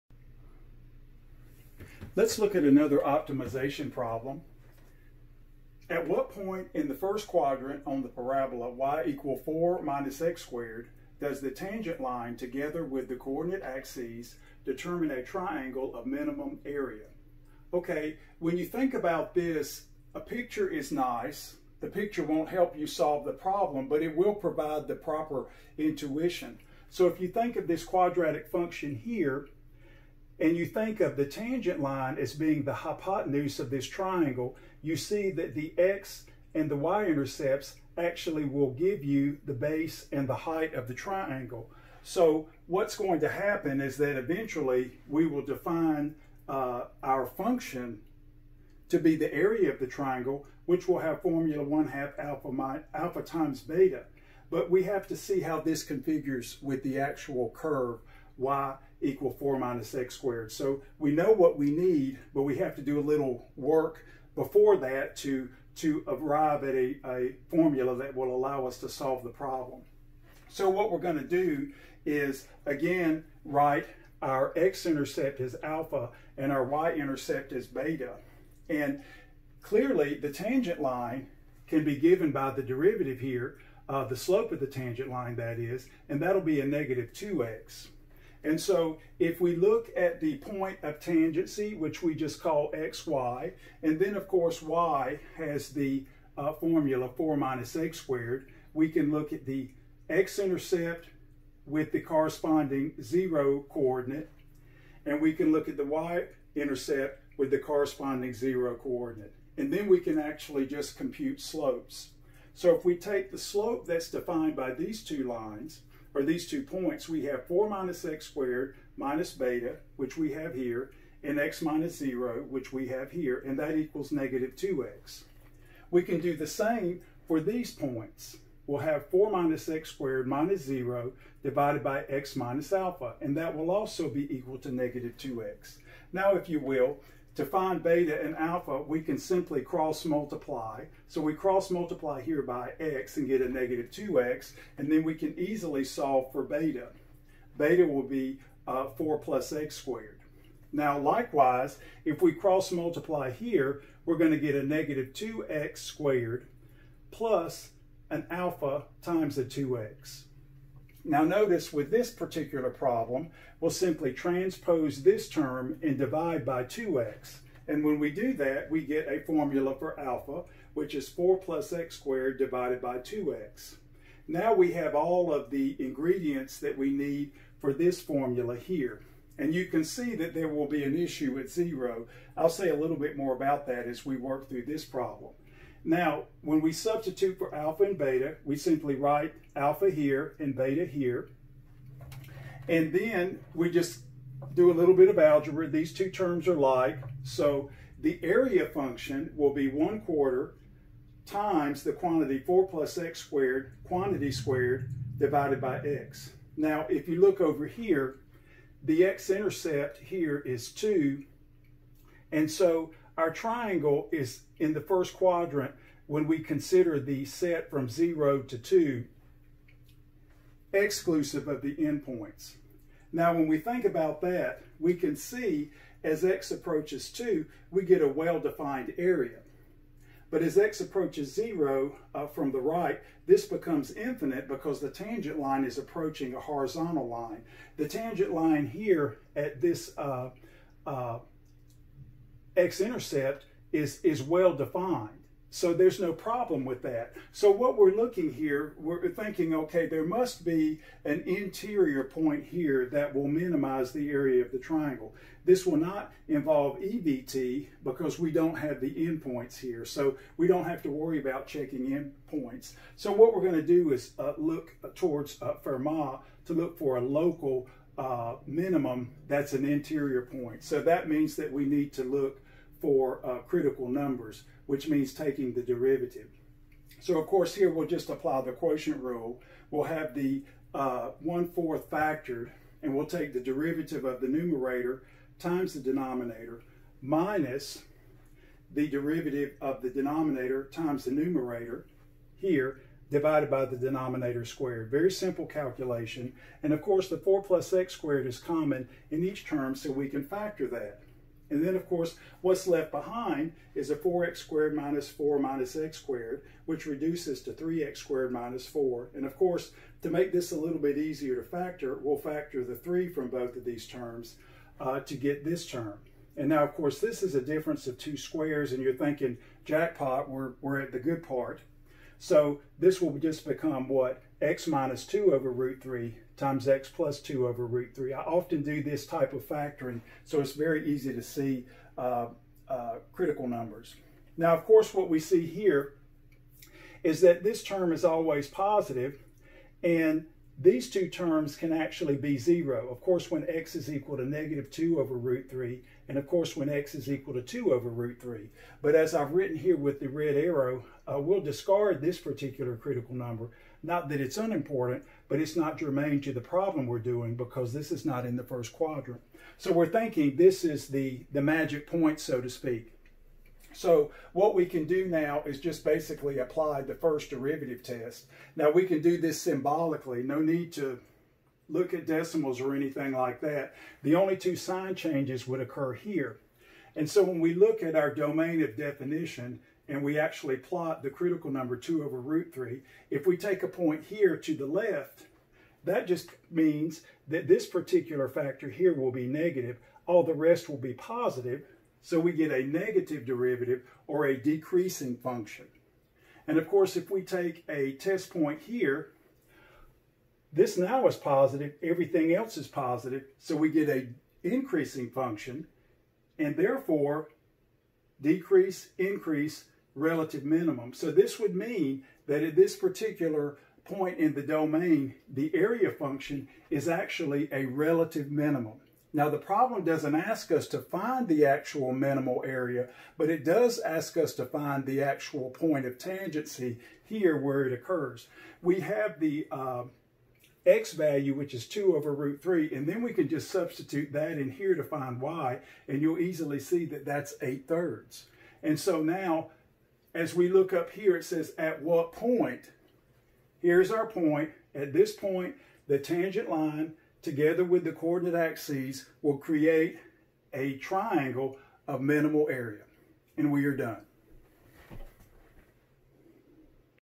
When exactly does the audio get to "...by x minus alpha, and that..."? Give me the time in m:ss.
2:11.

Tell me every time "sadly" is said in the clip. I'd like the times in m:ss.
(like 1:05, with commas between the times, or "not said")
not said.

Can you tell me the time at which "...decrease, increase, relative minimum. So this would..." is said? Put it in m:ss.
6:48.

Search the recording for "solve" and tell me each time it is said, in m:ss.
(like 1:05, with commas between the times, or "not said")
0:22, 1:08, 2:25.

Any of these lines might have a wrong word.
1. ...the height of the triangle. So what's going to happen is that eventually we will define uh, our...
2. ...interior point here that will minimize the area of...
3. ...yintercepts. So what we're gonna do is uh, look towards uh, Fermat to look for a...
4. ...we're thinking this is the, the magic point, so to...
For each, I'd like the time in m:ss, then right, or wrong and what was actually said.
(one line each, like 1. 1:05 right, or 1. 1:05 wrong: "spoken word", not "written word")
1. 0:40 right
2. 4:11 right
3. 4:22 wrong: "endpoints", not "yintercepts"
4. 5:59 right.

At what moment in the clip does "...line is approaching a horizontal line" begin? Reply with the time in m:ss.
3:55.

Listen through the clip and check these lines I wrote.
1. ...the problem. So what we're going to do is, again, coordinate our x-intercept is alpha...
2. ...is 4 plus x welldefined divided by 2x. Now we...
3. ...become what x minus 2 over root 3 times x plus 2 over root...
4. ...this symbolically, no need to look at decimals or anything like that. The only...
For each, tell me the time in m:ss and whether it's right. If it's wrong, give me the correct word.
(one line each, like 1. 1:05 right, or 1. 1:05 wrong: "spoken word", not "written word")
1. 1:09 wrong: "write", not "coordinate"
2. 2:50 wrong: "squared", not "welldefined"
3. 5:23 right
4. 6:09 right.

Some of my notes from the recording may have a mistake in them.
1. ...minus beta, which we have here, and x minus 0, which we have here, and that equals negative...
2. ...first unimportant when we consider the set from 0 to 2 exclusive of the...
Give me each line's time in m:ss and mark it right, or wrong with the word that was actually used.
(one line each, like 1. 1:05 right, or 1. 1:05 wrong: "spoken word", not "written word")
1. 1:58 right
2. 3:34 wrong: "quadrant", not "unimportant".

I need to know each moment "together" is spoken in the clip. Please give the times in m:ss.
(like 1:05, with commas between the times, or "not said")
0:12, 7:27.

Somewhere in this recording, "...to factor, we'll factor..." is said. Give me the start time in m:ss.
5:11.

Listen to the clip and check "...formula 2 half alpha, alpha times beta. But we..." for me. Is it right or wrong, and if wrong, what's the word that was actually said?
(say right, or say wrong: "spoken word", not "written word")
wrong: "1", not "2".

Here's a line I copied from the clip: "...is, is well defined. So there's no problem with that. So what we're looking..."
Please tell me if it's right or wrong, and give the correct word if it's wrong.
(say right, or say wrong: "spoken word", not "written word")
right.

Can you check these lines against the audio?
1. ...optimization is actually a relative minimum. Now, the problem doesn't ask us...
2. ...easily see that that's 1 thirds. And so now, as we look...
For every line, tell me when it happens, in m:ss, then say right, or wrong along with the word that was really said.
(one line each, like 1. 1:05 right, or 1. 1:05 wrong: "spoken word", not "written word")
1. 6:55 wrong: "function", not "optimization"
2. 7:16 wrong: "8", not "1".